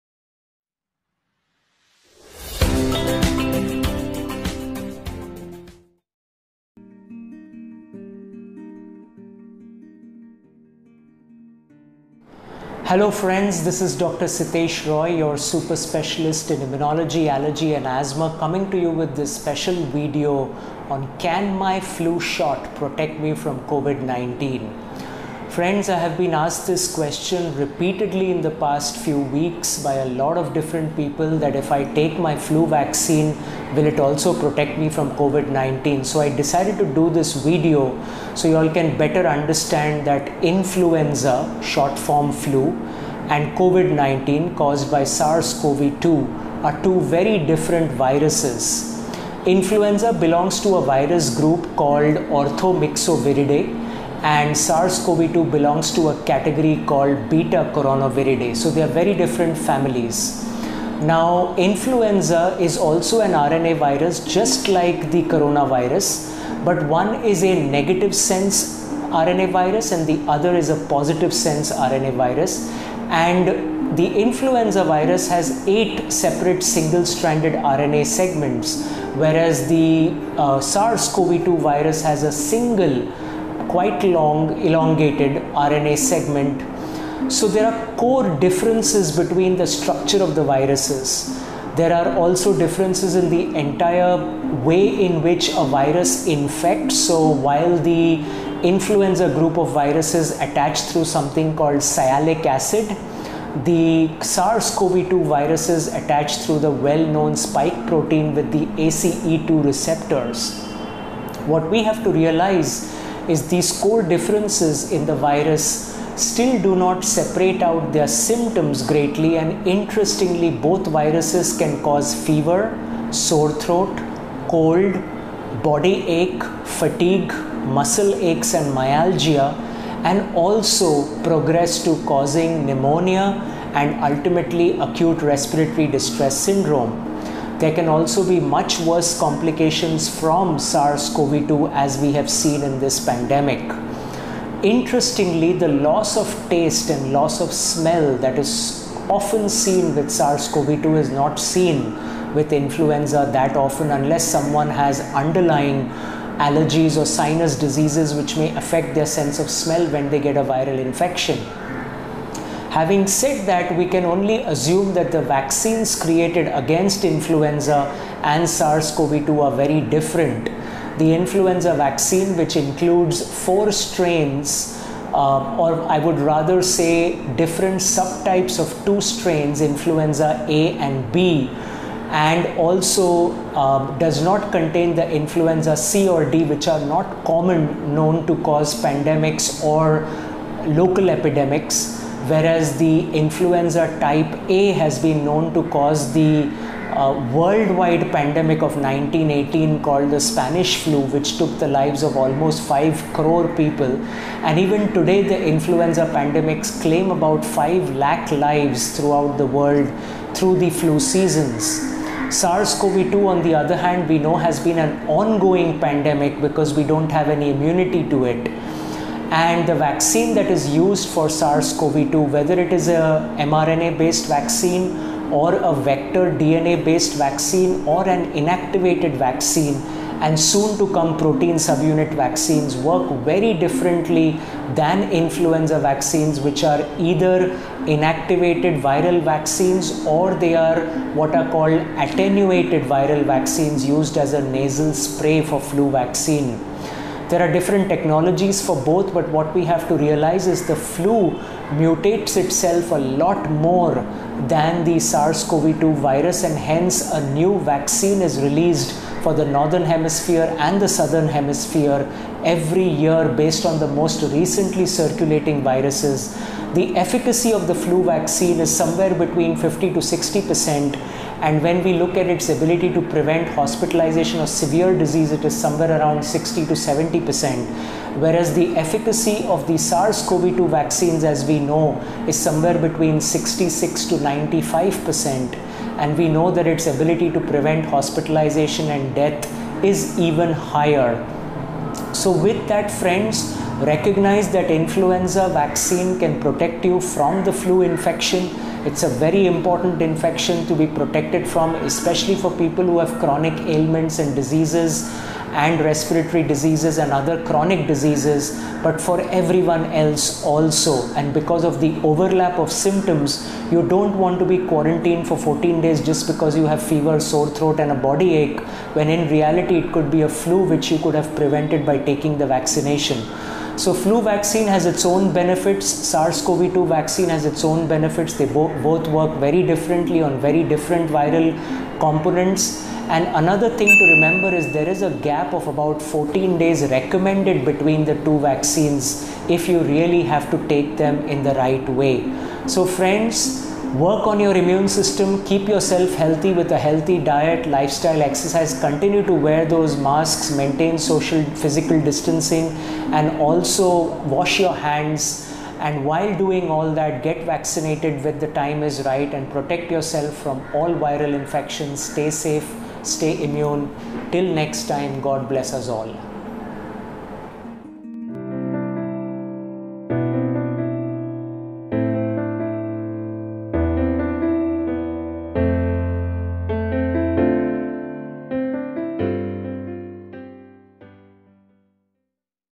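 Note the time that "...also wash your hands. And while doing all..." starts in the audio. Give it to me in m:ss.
5:53.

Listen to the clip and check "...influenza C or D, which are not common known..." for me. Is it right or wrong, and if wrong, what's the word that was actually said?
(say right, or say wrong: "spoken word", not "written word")
right.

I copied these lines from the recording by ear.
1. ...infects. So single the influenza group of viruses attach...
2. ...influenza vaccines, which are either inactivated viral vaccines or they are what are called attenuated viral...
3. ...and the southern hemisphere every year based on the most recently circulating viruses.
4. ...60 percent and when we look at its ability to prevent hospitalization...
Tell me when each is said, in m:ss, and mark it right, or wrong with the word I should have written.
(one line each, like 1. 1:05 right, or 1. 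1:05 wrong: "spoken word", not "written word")
1. 1:36 wrong: "while", not "single"
2. 3:55 right
3. 4:20 right
4. 4:30 right.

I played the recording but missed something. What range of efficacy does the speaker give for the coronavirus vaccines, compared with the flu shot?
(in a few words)
66 to 95 percent.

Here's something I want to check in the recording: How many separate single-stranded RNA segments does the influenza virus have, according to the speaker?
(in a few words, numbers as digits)
8.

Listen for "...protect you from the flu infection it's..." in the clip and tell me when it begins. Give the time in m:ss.
4:56.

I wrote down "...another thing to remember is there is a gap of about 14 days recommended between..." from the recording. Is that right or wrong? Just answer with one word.
right.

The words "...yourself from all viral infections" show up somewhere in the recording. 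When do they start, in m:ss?
5:59.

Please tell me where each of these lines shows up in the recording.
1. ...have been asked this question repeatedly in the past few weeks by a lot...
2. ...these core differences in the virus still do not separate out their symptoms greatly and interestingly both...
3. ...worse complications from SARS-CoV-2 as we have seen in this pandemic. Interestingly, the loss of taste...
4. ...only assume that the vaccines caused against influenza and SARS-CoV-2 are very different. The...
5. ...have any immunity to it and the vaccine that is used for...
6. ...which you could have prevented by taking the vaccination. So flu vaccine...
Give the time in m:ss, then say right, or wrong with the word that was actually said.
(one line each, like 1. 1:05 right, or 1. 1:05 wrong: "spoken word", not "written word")
1. 0:25 right
2. 1:53 right
3. 2:18 right
4. 2:44 wrong: "created", not "caused"
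5. 3:37 right
6. 5:20 right.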